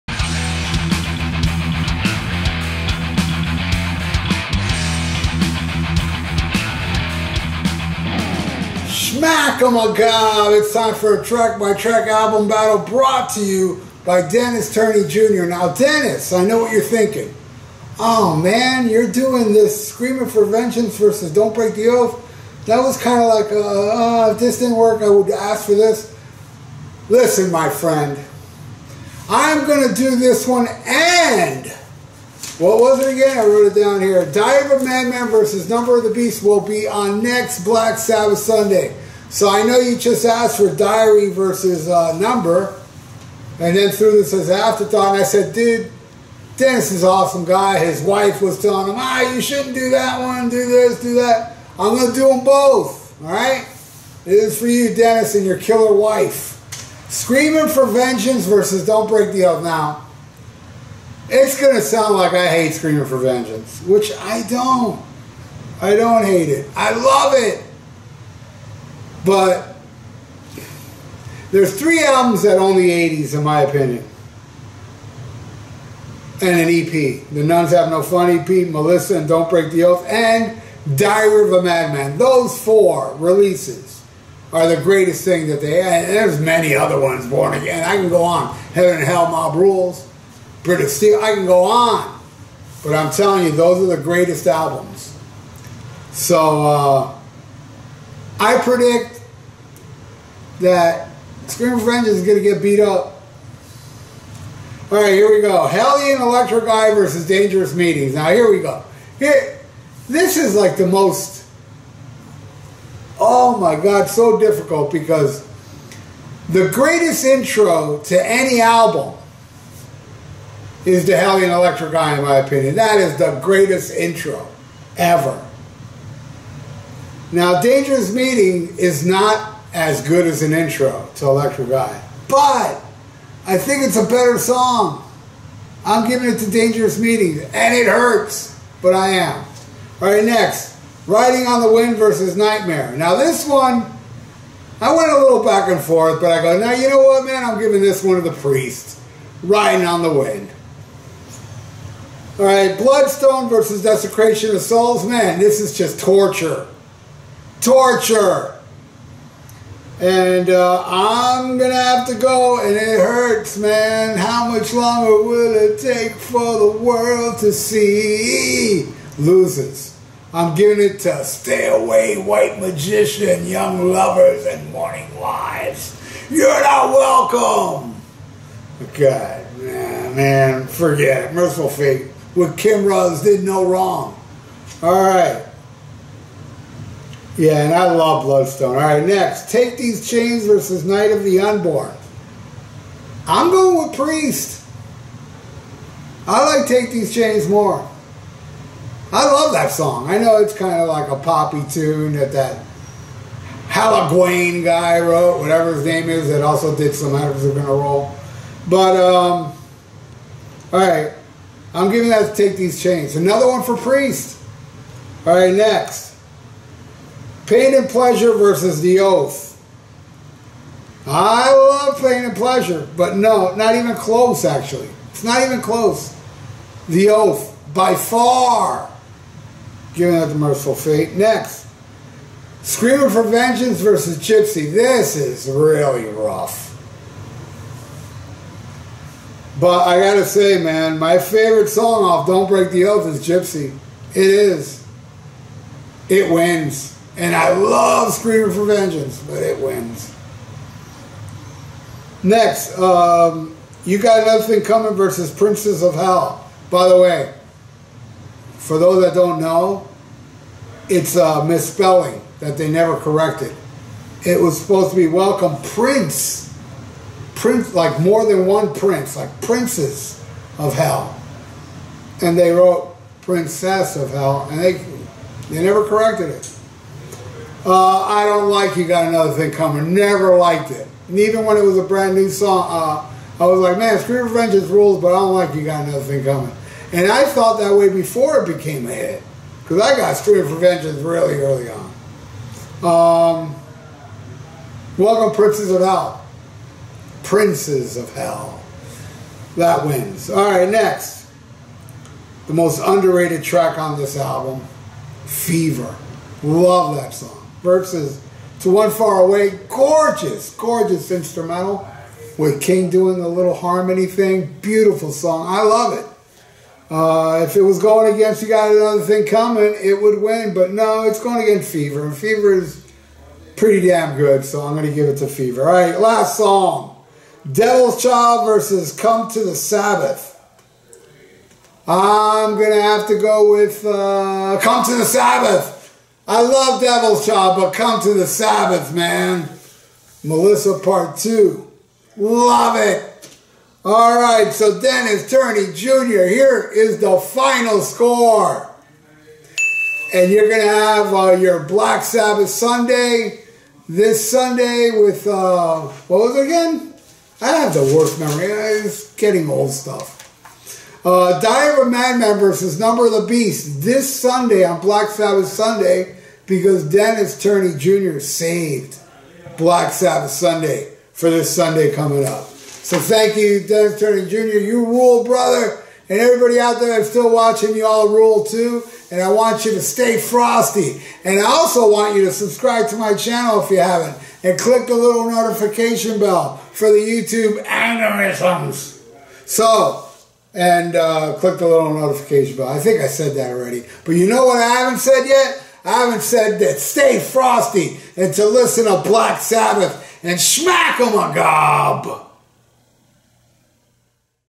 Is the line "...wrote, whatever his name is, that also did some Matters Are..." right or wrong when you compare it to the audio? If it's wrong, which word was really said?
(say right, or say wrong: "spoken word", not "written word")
right.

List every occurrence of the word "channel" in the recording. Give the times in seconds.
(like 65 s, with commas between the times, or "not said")
383 s.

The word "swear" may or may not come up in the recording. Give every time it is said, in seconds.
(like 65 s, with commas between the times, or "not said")
not said.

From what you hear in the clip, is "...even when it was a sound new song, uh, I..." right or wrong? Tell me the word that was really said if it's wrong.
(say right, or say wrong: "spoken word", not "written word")
wrong: "brand", not "sound".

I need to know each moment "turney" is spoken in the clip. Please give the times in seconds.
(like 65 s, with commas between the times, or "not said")
14 s, 345 s, 367 s, 373 s.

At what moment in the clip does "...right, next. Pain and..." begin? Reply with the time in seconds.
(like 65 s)
215 s.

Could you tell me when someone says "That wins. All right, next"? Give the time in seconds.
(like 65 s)
299 s.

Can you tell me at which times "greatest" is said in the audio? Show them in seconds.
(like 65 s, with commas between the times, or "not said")
84 s, 94 s, 116 s, 123 s.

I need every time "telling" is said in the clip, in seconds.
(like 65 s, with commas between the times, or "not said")
48 s, 93 s.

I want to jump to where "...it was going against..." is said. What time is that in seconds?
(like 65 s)
317 s.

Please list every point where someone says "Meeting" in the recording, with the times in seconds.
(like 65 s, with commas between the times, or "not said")
107 s, 128 s, 136 s.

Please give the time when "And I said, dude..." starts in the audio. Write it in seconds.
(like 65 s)
45 s.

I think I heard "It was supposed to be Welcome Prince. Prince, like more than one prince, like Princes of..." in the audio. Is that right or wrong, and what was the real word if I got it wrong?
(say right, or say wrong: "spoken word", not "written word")
right.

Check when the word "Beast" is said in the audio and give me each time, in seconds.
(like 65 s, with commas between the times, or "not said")
36 s, 363 s.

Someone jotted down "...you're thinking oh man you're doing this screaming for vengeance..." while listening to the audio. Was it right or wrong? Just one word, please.
right.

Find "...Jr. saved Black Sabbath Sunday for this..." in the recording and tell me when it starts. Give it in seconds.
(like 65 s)
367 s.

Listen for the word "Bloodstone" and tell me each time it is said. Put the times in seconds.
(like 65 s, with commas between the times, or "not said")
152 s, 188 s.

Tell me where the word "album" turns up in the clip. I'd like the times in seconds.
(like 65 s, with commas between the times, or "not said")
12 s, 72 s, 94 s, 118 s, 304 s.